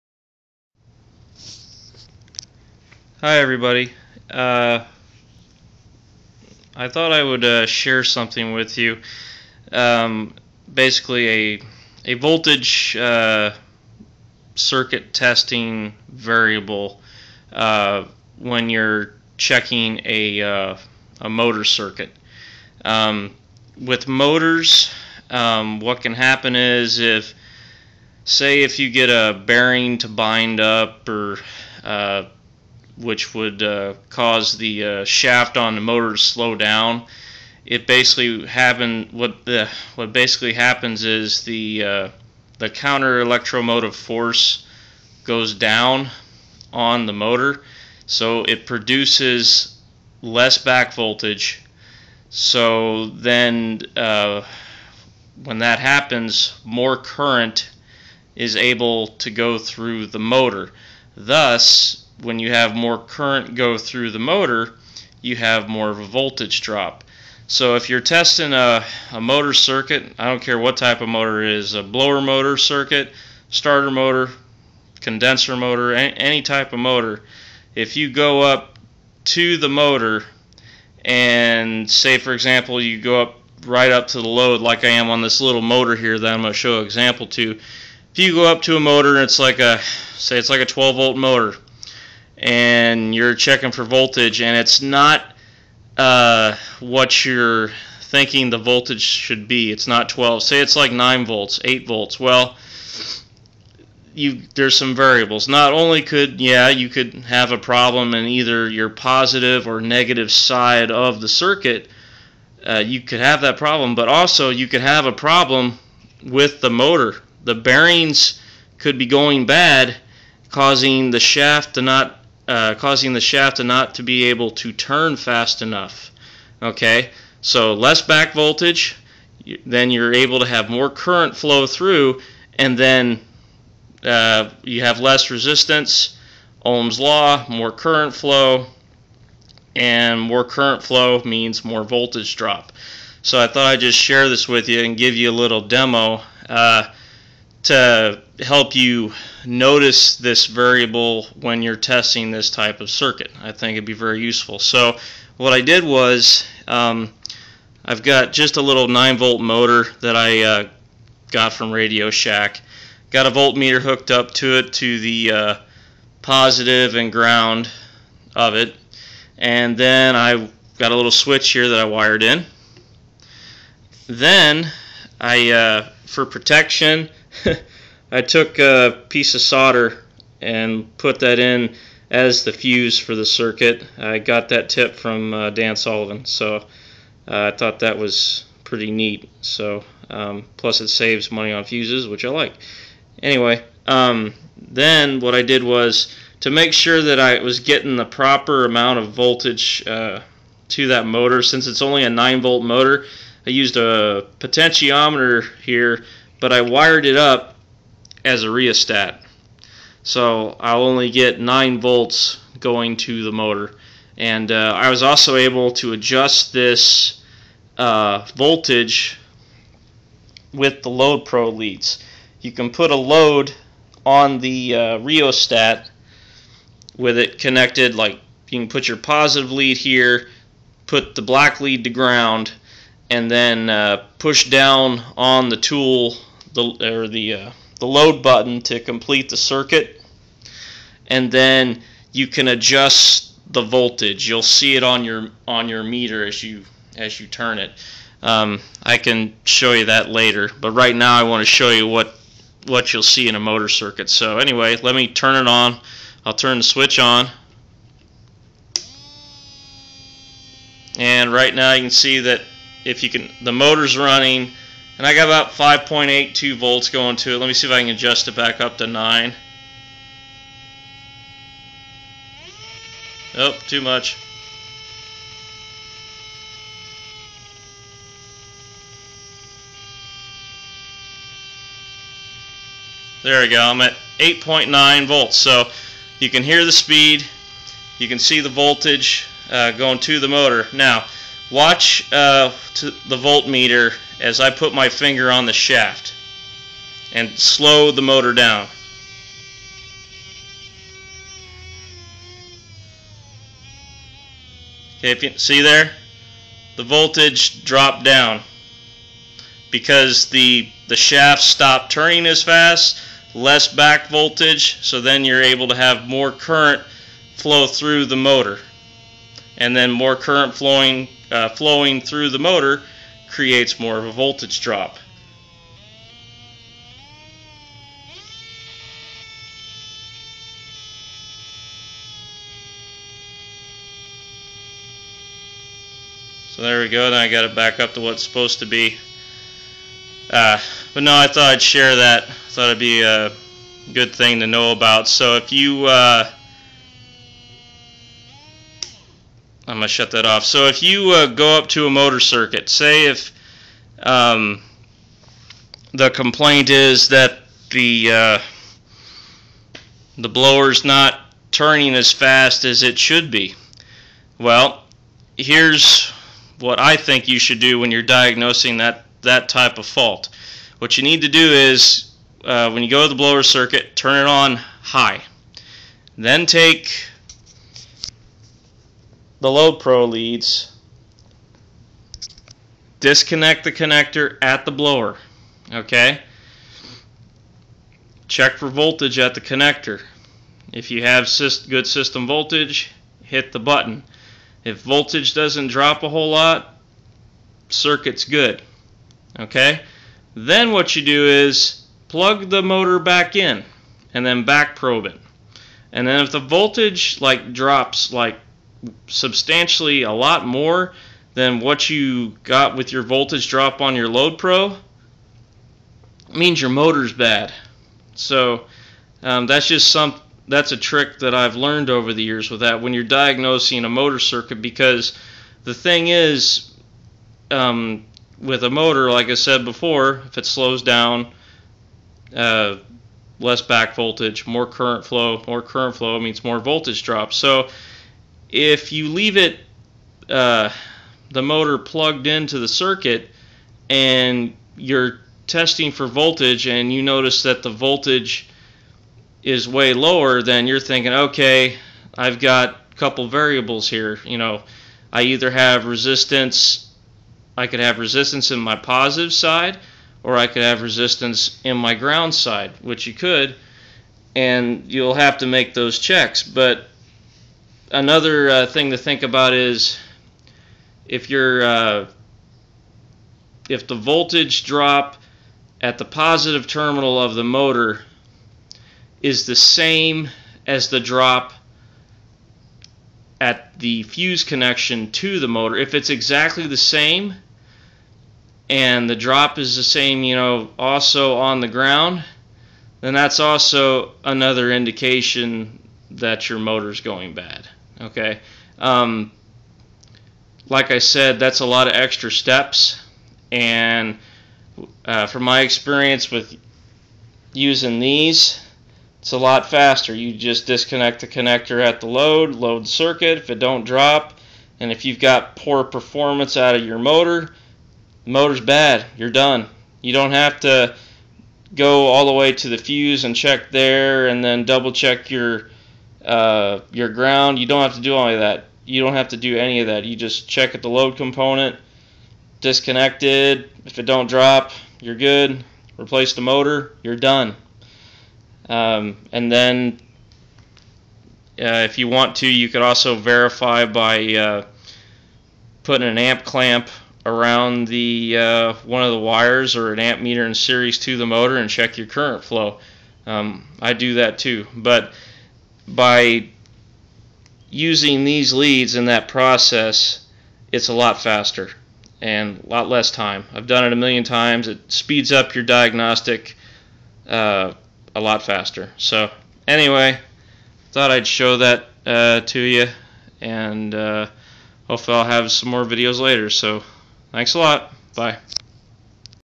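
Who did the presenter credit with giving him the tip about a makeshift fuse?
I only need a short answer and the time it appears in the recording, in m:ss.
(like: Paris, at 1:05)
Dan Sullivan, at 3:05.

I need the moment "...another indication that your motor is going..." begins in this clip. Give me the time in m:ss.
8:14.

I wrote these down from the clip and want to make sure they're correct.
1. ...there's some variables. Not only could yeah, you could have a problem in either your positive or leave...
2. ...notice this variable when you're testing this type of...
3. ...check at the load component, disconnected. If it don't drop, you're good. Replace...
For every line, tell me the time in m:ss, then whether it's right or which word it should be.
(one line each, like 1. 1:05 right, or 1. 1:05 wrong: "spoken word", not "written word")
1. 1:44 wrong: "negative", not "leave"
2. 2:29 right
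3. 8:50 right.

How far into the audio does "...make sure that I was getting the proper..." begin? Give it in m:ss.
3:16.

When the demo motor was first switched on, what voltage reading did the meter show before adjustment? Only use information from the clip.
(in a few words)
5.82 volts.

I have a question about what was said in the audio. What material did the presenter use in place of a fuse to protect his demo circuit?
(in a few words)
solder.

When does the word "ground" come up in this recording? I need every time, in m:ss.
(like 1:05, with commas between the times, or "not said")
2:47, 3:51, 7:41, 8:11, 8:47.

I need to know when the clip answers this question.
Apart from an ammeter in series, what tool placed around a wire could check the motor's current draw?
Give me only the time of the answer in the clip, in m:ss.
9:06.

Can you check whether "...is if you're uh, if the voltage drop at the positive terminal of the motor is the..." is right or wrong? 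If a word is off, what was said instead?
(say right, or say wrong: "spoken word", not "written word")
right.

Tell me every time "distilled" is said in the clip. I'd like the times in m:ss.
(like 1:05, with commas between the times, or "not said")
not said.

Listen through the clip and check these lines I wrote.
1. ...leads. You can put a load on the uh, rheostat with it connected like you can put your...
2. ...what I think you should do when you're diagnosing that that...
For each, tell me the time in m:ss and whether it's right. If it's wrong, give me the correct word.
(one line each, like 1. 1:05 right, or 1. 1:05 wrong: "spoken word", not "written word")
1. 3:41 right
2. 6:06 right.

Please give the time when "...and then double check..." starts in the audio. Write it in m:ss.
8:44.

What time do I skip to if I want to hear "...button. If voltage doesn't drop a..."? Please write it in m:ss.
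6:33.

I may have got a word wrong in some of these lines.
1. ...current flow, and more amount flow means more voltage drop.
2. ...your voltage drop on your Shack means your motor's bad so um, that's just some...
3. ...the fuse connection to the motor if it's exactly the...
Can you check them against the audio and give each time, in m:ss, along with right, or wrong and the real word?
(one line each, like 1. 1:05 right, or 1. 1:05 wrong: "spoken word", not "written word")
1. 2:17 wrong: "current", not "amount"
2. 6:52 wrong: "Loadpro", not "Shack"
3. 8:03 right.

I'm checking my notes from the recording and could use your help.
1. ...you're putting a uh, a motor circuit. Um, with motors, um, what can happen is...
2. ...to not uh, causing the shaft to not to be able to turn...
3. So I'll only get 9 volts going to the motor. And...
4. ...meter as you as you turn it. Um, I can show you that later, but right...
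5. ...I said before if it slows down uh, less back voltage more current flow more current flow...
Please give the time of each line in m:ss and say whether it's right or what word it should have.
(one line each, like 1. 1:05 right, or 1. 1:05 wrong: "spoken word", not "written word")
1. 0:18 wrong: "checking", not "putting"
2. 2:01 right
3. 3:30 right
4. 4:05 right
5. 7:09 right.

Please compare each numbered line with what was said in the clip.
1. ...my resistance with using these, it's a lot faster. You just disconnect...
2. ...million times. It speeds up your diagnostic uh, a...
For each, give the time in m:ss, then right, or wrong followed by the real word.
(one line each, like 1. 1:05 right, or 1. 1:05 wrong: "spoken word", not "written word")
1. 8:25 wrong: "experience", not "resistance"
2. 9:23 right.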